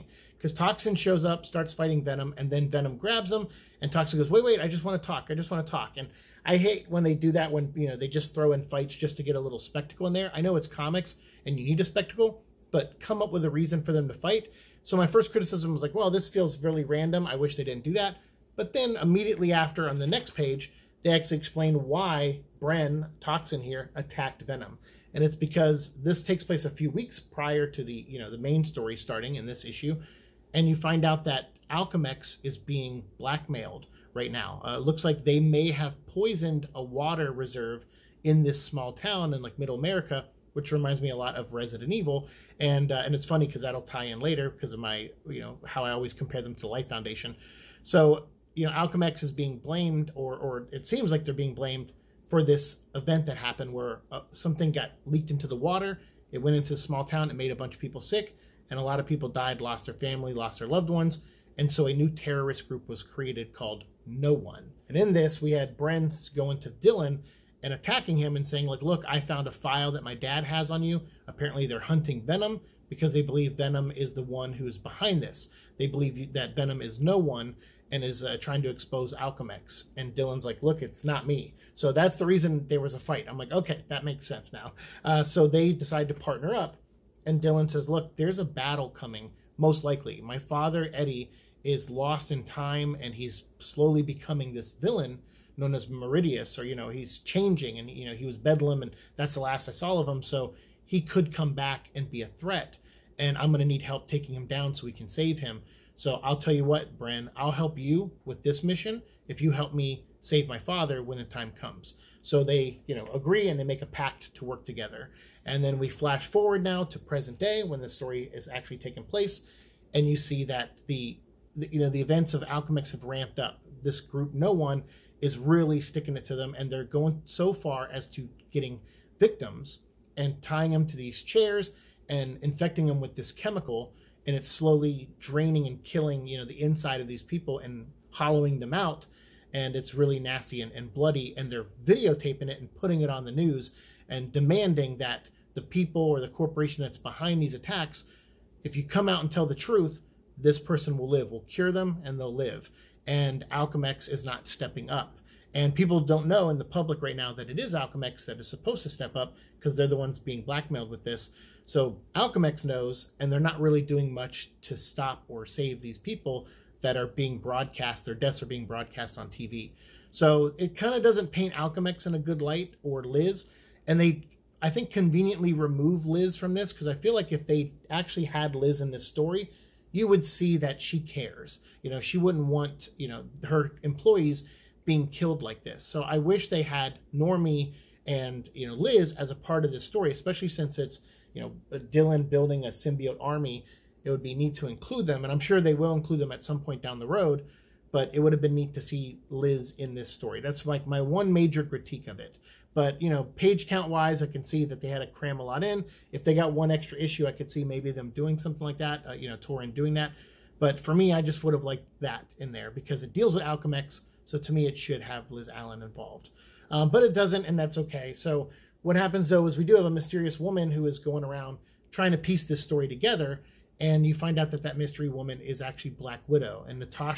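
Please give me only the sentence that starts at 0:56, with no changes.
It went into a small town.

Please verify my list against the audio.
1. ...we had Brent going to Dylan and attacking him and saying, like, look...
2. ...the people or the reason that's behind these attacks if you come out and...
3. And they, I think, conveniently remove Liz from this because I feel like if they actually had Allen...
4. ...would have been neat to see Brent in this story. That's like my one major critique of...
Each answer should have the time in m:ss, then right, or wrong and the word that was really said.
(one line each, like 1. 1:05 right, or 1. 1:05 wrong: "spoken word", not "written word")
1. 1:05 right
2. 2:25 wrong: "corporation", not "reason"
3. 2:53 wrong: "Liz", not "Allen"
4. 3:18 wrong: "Liz", not "Brent".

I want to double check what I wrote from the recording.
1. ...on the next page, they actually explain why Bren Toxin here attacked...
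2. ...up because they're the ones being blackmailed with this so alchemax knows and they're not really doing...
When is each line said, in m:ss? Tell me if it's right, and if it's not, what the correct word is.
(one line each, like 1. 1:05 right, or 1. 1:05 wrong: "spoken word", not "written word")
1. 0:19 right
2. 2:39 right.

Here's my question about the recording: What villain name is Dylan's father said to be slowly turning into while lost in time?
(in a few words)
Meridius.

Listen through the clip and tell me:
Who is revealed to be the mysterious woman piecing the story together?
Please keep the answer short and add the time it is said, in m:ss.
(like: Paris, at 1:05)
Black Widow, at 3:45.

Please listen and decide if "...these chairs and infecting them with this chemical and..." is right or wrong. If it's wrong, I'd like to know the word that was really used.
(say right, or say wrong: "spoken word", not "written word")
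right.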